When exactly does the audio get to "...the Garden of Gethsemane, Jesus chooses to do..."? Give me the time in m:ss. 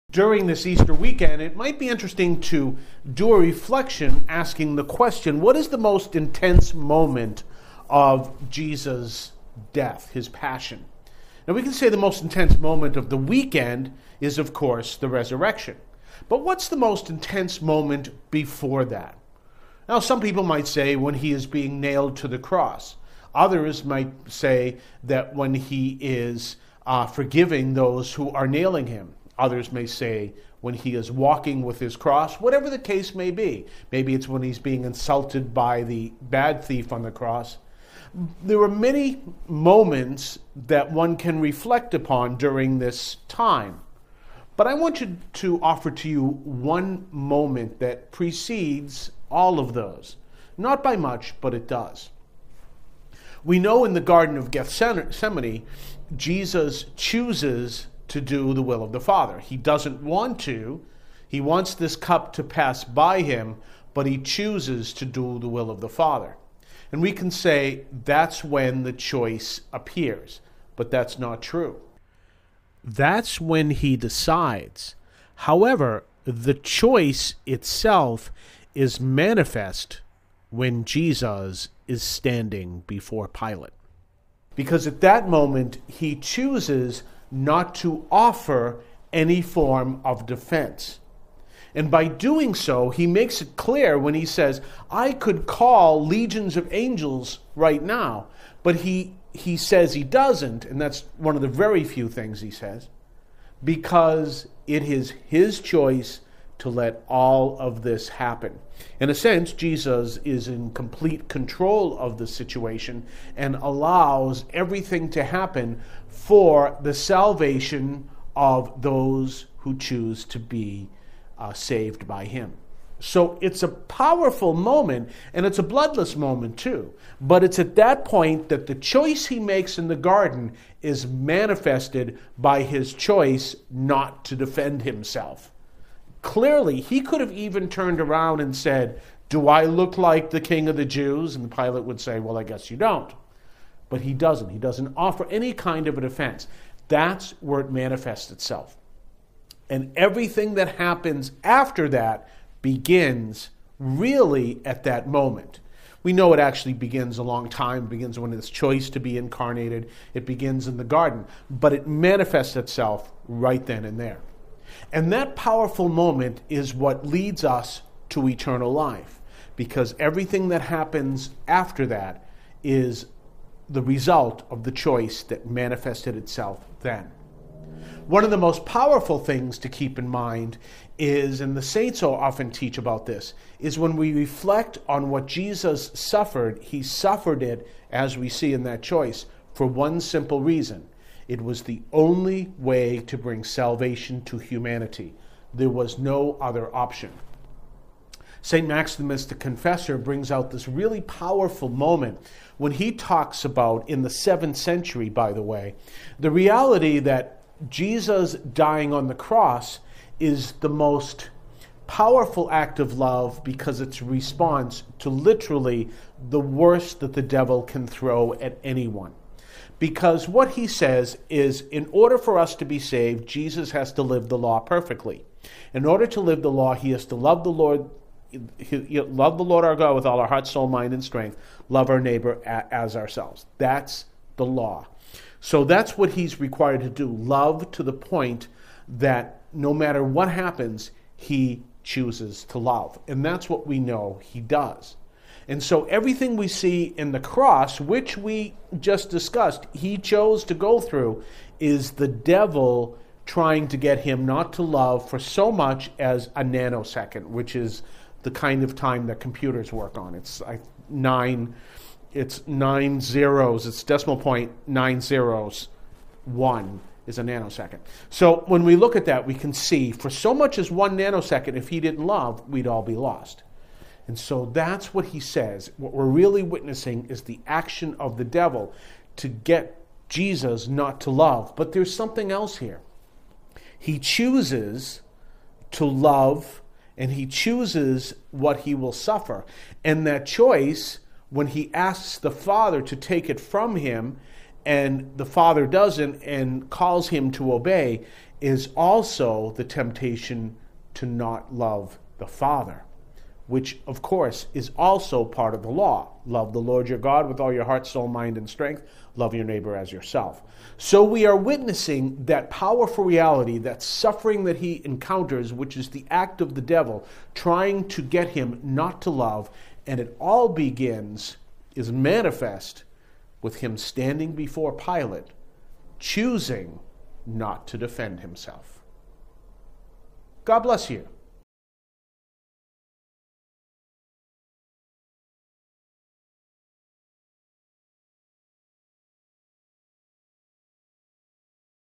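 0:53.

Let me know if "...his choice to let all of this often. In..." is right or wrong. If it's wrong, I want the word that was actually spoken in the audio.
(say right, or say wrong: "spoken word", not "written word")
wrong: "happen", not "often".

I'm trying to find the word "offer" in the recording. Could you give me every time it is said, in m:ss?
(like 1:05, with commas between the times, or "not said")
0:45, 1:28, 2:24.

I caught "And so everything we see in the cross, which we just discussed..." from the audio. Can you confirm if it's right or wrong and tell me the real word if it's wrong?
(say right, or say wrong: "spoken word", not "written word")
right.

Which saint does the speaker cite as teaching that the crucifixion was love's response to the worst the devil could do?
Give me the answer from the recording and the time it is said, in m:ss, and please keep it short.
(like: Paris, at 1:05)
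St. Maximus the Confessor, at 3:18.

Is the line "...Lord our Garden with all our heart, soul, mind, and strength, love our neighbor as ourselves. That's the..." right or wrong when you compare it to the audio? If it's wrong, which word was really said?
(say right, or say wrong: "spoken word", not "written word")
wrong: "God", not "Garden".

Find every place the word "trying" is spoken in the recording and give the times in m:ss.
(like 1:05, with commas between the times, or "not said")
4:13, 5:17.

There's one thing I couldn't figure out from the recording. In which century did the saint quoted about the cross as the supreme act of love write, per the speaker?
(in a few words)
7th century.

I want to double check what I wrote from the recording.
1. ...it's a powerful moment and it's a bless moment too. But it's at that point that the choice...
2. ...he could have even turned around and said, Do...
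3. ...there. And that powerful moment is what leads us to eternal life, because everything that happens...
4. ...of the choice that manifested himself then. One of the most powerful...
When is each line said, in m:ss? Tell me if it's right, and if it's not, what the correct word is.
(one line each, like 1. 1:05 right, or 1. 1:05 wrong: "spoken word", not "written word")
1. 2:03 wrong: "bloodless", not "bless"
2. 2:16 right
3. 2:43 right
4. 2:54 wrong: "itself", not "himself".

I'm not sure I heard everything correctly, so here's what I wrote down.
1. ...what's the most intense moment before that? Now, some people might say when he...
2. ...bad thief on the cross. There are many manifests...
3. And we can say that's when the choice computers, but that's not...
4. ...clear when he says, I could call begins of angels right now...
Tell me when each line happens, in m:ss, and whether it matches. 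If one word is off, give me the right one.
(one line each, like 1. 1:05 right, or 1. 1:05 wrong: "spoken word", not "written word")
1. 0:16 right
2. 0:36 wrong: "moments", not "manifests"
3. 1:06 wrong: "appears", not "computers"
4. 1:33 wrong: "legions", not "begins".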